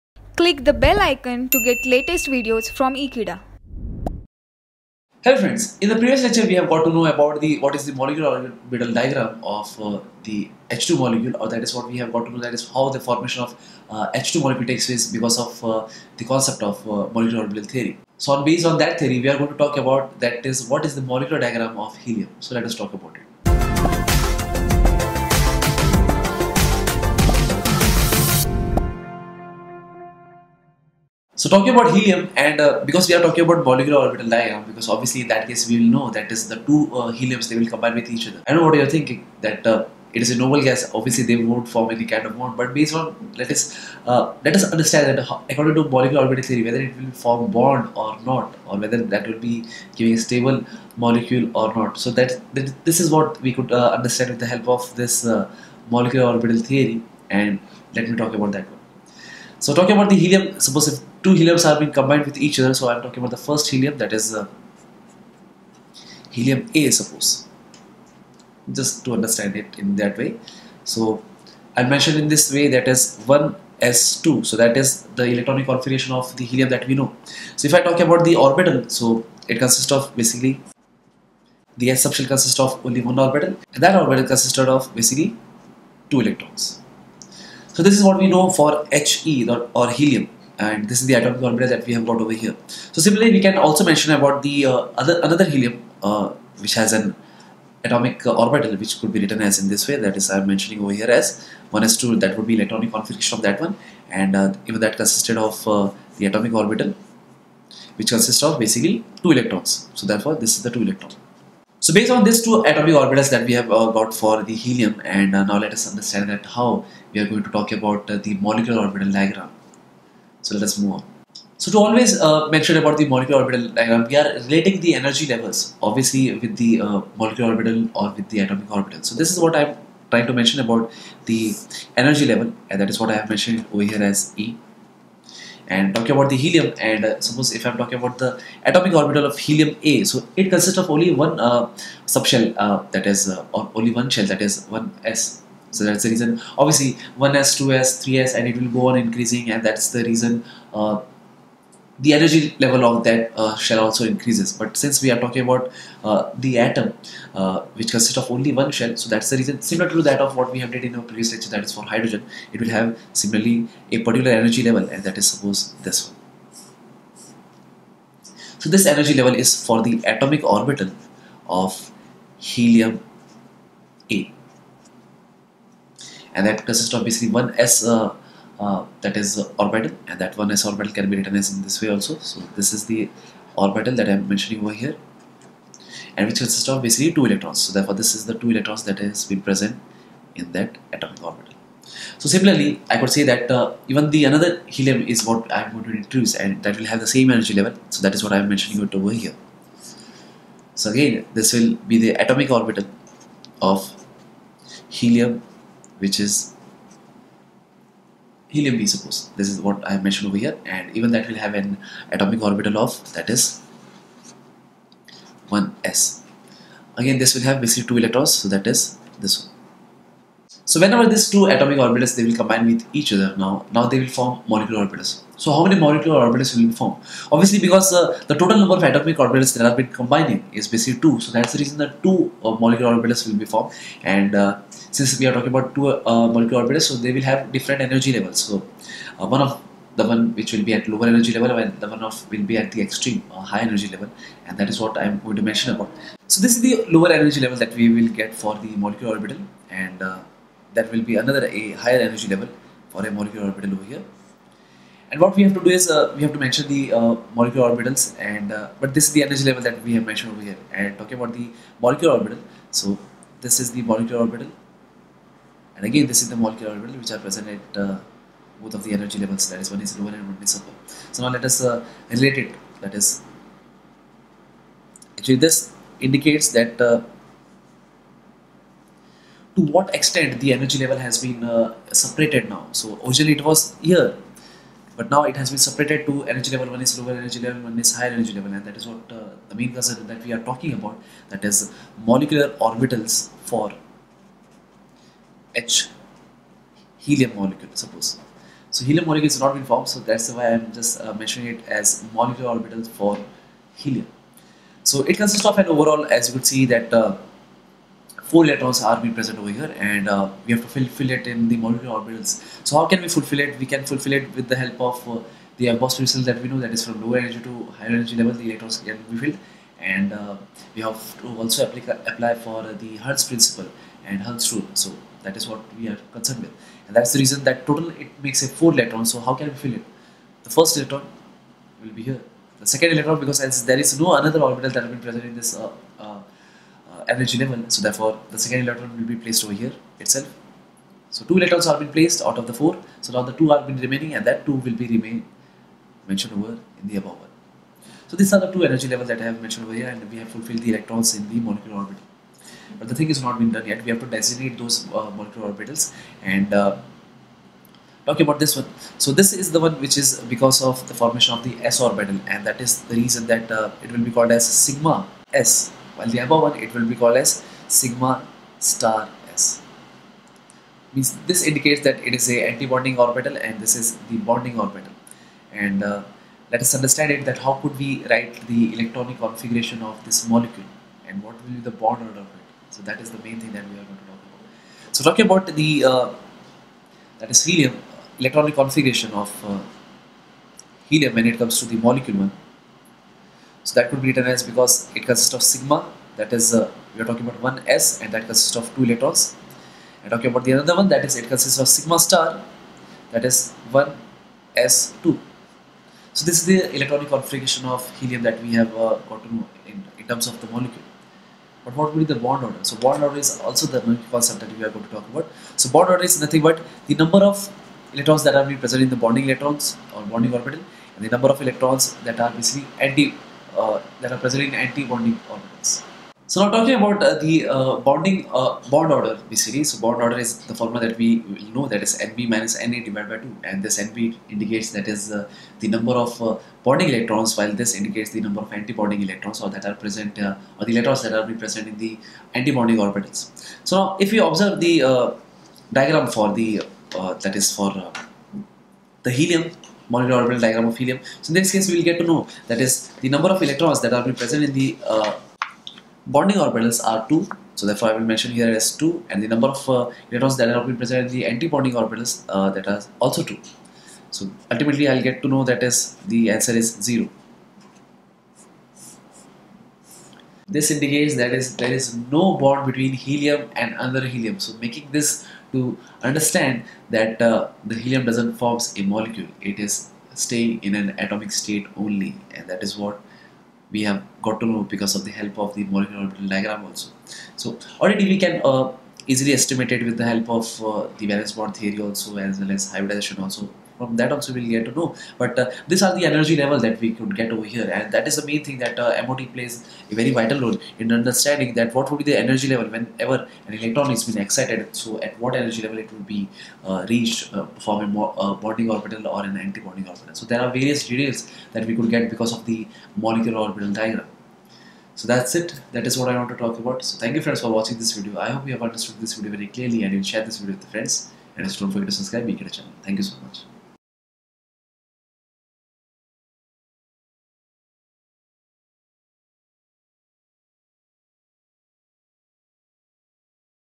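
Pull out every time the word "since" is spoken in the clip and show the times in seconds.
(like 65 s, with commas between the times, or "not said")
154 s, 234 s.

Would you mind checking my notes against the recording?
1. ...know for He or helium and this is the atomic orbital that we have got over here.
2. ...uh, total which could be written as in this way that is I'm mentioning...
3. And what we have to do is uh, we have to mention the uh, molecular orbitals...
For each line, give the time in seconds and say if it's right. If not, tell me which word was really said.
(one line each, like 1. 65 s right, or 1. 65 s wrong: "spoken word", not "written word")
1. 88 s right
2. 98 s wrong: "orbital", not "total"
3. 255 s right.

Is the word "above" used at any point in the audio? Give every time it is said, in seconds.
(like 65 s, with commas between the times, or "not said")
347 s, 366 s.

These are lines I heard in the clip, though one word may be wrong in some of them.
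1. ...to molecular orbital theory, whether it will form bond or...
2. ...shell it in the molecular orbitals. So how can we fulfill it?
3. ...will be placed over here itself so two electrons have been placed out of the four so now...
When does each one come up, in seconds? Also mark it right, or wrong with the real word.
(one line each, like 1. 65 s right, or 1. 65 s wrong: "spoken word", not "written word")
1. 45 s right
2. 310 s wrong: "fulfill", not "shell"
3. 338 s right.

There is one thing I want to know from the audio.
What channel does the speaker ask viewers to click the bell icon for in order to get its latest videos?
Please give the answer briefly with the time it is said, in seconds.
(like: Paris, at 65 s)
Ekeeda, at 3 s.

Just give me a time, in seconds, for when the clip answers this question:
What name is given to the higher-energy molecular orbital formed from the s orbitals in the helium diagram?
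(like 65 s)
367 s.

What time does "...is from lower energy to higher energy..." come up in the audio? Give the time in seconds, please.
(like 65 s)
316 s.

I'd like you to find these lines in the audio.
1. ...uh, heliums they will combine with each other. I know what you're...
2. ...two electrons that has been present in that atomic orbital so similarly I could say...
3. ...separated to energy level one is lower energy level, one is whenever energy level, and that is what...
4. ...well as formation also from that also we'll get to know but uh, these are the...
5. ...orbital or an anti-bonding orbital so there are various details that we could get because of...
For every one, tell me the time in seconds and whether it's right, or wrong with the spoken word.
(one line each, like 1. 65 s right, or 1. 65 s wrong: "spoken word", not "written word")
1. 36 s right
2. 188 s right
3. 285 s wrong: "higher", not "whenever"
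4. 492 s wrong: "hybridization", not "formation"
5. 508 s right.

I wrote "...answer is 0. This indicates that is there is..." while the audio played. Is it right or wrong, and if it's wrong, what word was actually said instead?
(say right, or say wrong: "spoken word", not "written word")
right.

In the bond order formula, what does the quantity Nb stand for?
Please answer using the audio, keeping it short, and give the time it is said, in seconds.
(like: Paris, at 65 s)
number of bonding electrons, at 435 s.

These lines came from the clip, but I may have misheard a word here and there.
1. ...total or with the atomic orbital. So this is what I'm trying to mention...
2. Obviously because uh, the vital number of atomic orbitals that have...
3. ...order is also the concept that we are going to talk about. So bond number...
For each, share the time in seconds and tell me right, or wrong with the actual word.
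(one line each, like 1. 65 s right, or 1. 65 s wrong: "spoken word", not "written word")
1. 127 s wrong: "orbital", not "total"
2. 227 s wrong: "total", not "vital"
3. 413 s wrong: "order", not "number".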